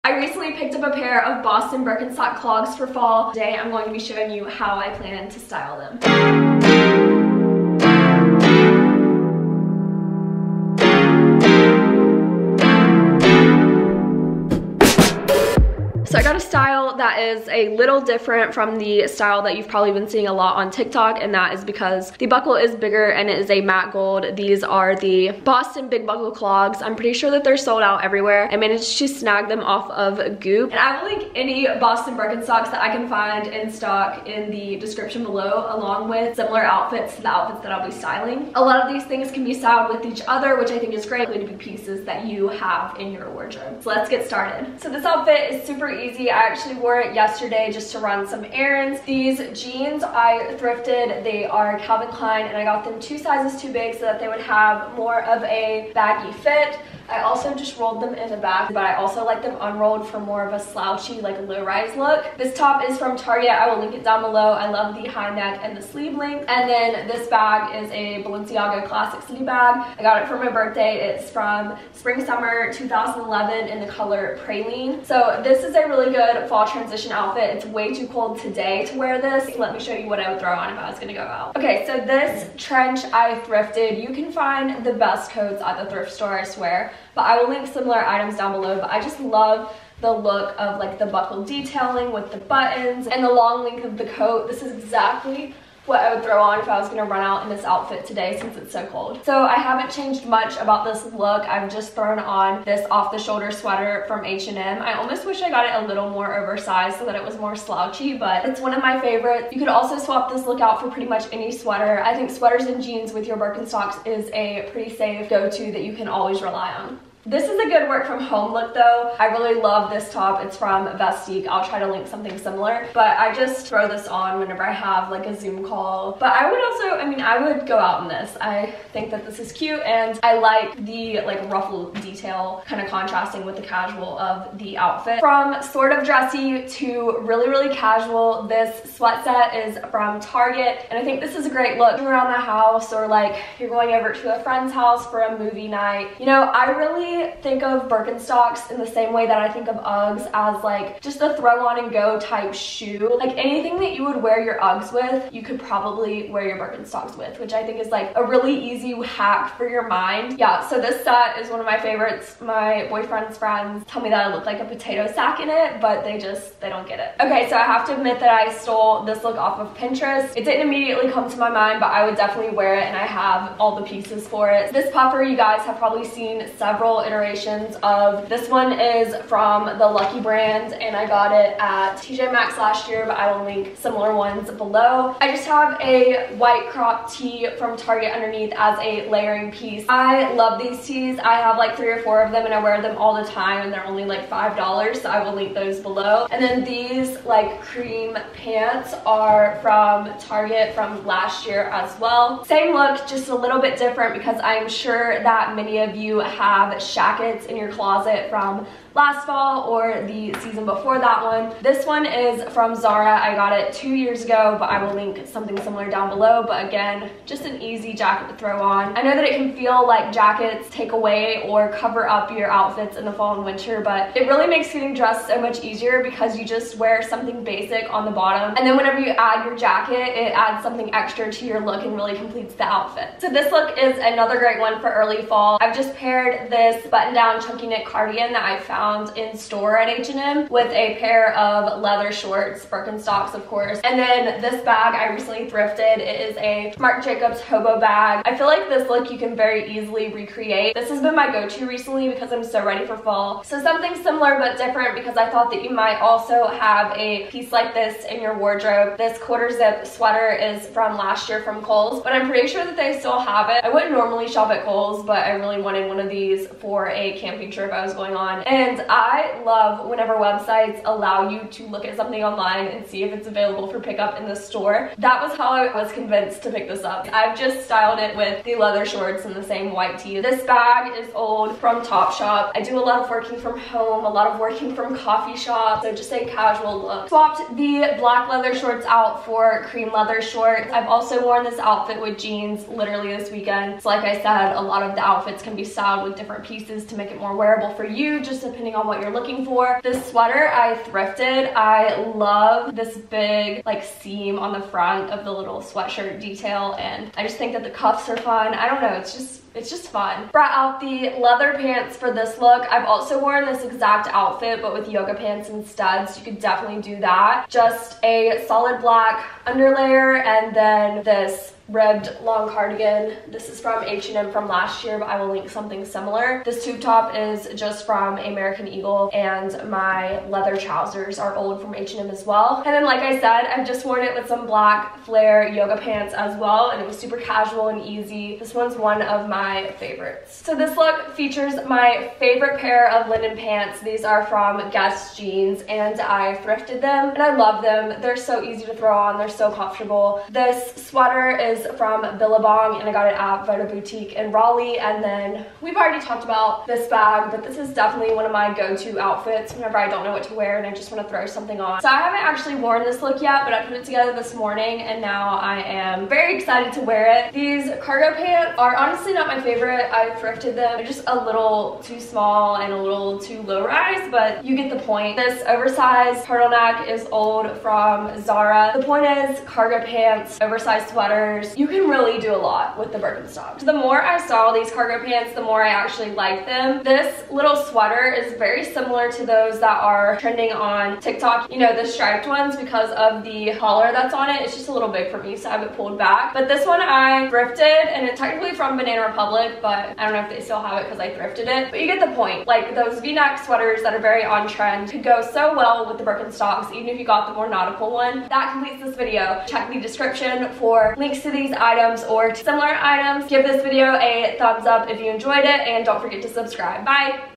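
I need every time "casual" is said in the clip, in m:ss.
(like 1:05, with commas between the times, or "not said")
2:13, 2:17, 4:46, 5:37.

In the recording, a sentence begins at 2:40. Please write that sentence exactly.
Yeah, so this set is one of my favorites.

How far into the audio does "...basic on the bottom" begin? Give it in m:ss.
3:47.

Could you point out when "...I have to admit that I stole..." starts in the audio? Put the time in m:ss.
2:47.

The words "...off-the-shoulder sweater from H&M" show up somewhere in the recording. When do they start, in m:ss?
1:42.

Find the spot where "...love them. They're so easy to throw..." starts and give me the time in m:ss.
5:47.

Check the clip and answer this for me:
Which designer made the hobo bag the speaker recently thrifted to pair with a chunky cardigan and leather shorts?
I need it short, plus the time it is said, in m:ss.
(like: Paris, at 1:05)
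Marc Jacobs, at 4:06.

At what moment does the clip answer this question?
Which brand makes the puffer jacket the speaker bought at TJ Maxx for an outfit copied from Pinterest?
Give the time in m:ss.
2:59.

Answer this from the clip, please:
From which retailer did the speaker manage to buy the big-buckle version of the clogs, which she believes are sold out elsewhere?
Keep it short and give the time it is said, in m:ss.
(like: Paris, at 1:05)
Goop, at 0:30.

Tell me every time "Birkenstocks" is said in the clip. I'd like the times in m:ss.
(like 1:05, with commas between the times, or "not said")
0:01, 0:32, 1:53, 2:27, 2:36, 4:02, 6:22, 6:46.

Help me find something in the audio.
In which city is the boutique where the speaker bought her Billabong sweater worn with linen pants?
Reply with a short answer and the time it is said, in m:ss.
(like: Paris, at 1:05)
Raleigh, at 5:54.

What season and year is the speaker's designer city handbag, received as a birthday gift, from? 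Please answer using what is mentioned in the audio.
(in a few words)
Spring Summer 2011.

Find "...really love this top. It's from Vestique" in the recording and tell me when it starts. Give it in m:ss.
1:59.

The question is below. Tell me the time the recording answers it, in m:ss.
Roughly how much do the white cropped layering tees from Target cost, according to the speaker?
3:14.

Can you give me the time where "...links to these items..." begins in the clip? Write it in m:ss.
6:50.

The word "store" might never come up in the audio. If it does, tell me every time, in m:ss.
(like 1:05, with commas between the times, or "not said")
1:26, 3:59, 4:34.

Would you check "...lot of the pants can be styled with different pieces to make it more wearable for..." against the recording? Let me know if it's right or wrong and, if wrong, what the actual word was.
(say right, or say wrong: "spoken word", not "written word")
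wrong: "outfits", not "pants".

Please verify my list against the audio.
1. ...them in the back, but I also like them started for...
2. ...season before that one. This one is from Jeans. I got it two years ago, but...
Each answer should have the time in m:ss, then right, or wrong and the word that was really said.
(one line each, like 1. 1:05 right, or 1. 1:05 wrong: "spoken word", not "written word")
1. 0:58 wrong: "unrolled", not "started"
2. 3:30 wrong: "Zara", not "Jeans".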